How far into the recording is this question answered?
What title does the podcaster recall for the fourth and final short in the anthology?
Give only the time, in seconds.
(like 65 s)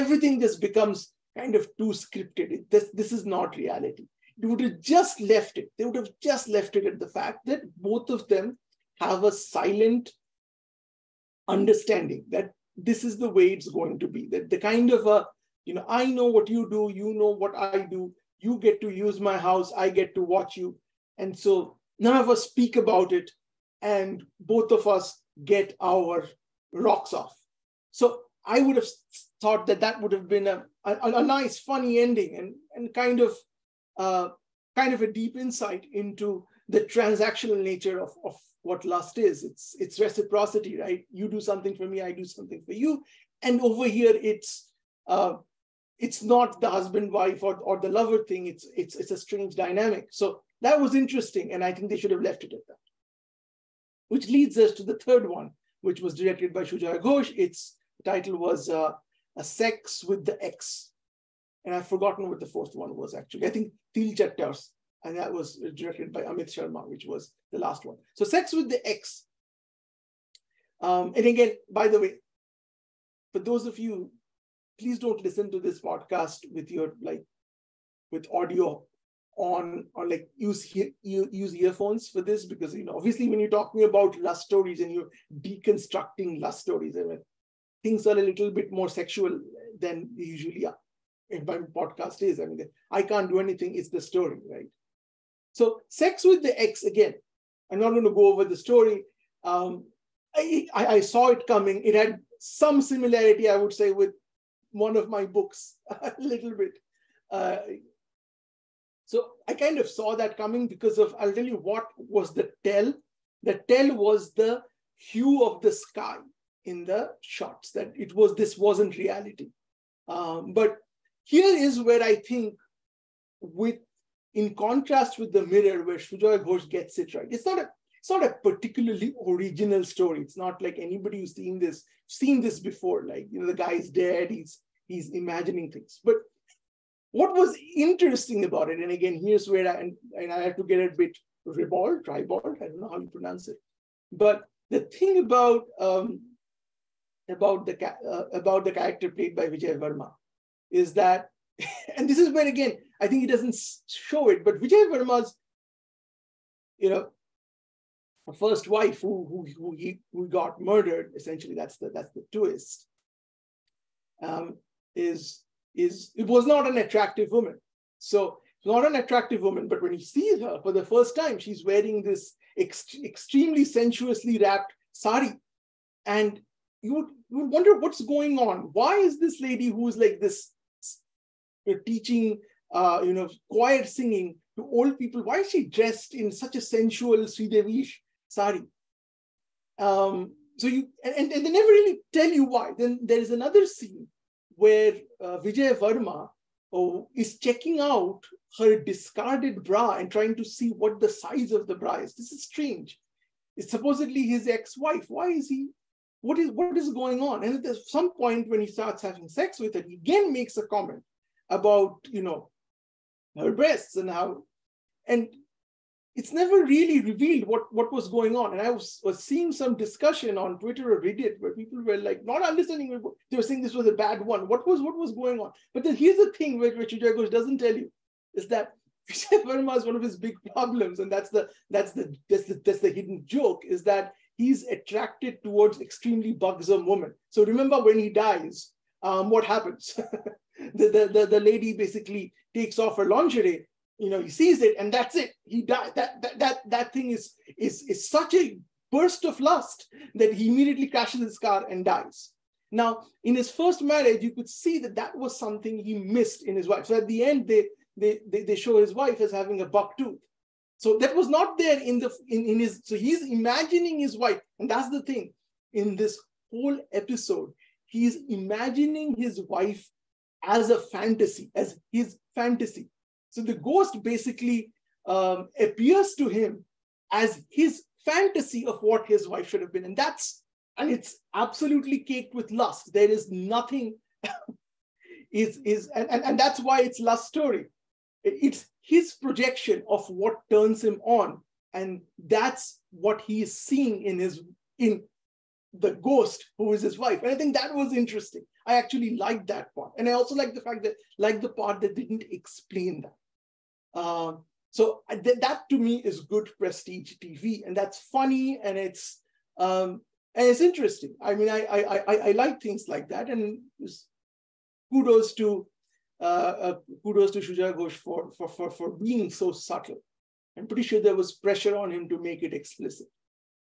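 63 s.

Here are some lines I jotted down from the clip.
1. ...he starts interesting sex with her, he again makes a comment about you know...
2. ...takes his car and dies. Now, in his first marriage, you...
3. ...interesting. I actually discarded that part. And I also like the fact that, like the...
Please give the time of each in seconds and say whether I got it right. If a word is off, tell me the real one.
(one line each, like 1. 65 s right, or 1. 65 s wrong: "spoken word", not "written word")
1. 208 s wrong: "having", not "interesting"
2. 250 s wrong: "crashes", not "takes"
3. 297 s wrong: "liked", not "discarded".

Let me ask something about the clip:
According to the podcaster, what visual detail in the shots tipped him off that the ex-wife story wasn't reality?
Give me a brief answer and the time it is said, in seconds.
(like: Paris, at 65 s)
The hue of the sky, at 114 s.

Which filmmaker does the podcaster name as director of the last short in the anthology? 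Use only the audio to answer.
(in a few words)
Amit Sharma.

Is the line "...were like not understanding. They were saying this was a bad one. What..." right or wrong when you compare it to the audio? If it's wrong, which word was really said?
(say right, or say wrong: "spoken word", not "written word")
right.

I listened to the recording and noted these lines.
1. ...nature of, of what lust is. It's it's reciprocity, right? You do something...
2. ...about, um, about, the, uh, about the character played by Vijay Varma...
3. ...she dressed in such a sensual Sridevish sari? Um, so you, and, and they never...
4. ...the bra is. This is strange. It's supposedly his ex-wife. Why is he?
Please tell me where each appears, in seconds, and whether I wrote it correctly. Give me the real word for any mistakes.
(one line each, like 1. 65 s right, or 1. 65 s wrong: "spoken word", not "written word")
1. 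37 s right
2. 145 s right
3. 185 s right
4. 201 s right.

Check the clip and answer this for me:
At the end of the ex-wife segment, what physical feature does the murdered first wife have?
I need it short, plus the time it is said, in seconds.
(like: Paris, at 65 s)
A buck tooth, at 259 s.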